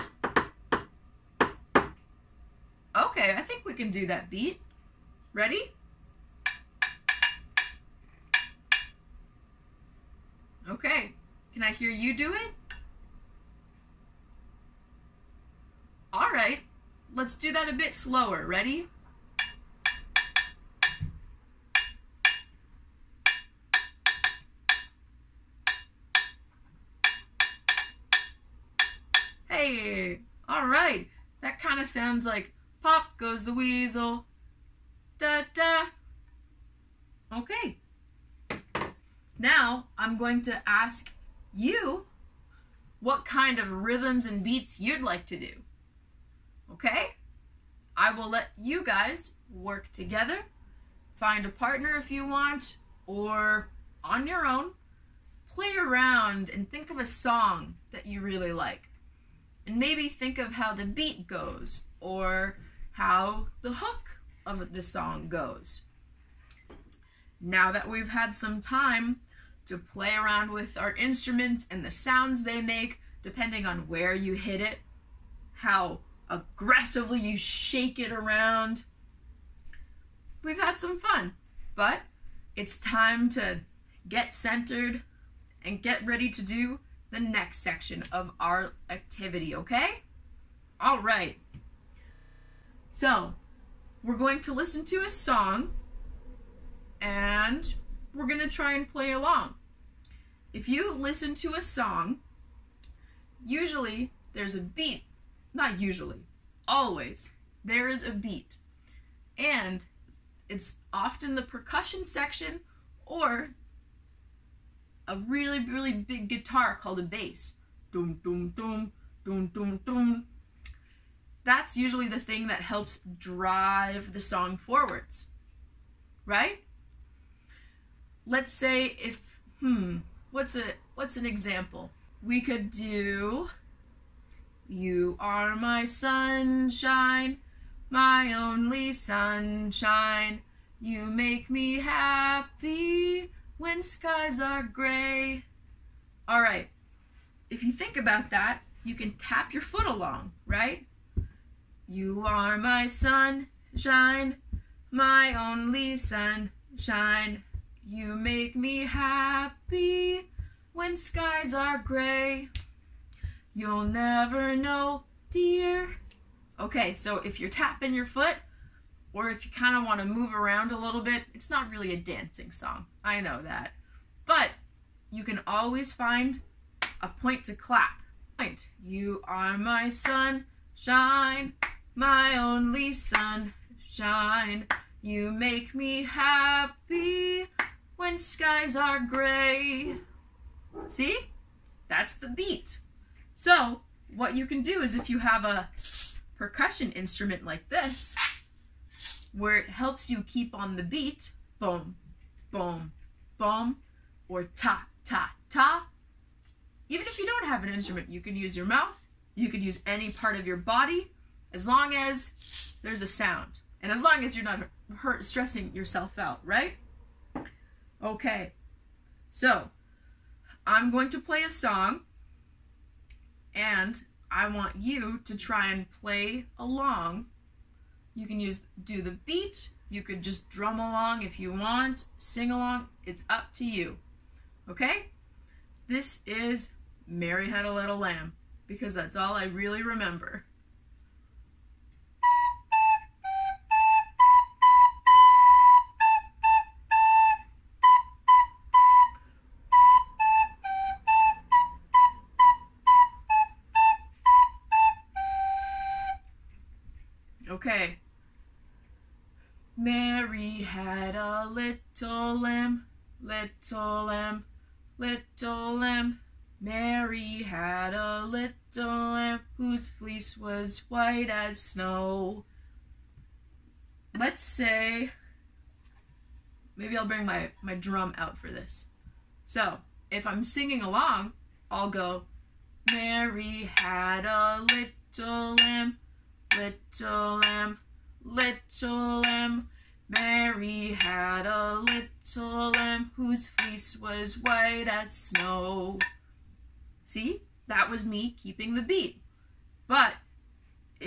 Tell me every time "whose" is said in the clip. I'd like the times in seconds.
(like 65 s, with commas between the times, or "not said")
269 s, 293 s.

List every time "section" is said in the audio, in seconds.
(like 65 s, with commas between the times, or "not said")
87 s, 112 s.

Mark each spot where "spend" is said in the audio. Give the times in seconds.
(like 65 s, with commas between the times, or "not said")
not said.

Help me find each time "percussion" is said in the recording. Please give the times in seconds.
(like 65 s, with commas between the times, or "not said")
111 s, 196 s.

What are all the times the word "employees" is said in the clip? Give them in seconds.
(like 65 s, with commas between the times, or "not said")
not said.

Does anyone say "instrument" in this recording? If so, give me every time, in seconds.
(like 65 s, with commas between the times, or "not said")
70 s, 196 s, 207 s.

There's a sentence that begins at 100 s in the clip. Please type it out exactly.
If you listen to a song, usually there's a beat not usually.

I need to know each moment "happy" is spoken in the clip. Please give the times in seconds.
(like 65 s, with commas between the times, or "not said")
141 s, 158 s, 186 s.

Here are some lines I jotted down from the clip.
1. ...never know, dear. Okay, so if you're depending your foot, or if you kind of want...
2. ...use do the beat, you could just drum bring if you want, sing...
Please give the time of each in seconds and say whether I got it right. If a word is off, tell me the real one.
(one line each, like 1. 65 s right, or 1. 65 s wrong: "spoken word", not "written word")
1. 163 s wrong: "tapping", not "depending"
2. 228 s wrong: "along", not "bring".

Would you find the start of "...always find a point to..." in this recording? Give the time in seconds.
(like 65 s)
175 s.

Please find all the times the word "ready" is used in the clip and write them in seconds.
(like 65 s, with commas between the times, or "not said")
5 s, 18 s, 86 s.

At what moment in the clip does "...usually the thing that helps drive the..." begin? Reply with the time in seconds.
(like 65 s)
121 s.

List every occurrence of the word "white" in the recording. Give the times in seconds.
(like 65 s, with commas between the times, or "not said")
270 s, 294 s.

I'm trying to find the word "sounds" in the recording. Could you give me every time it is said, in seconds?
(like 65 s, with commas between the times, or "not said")
31 s, 71 s, 213 s.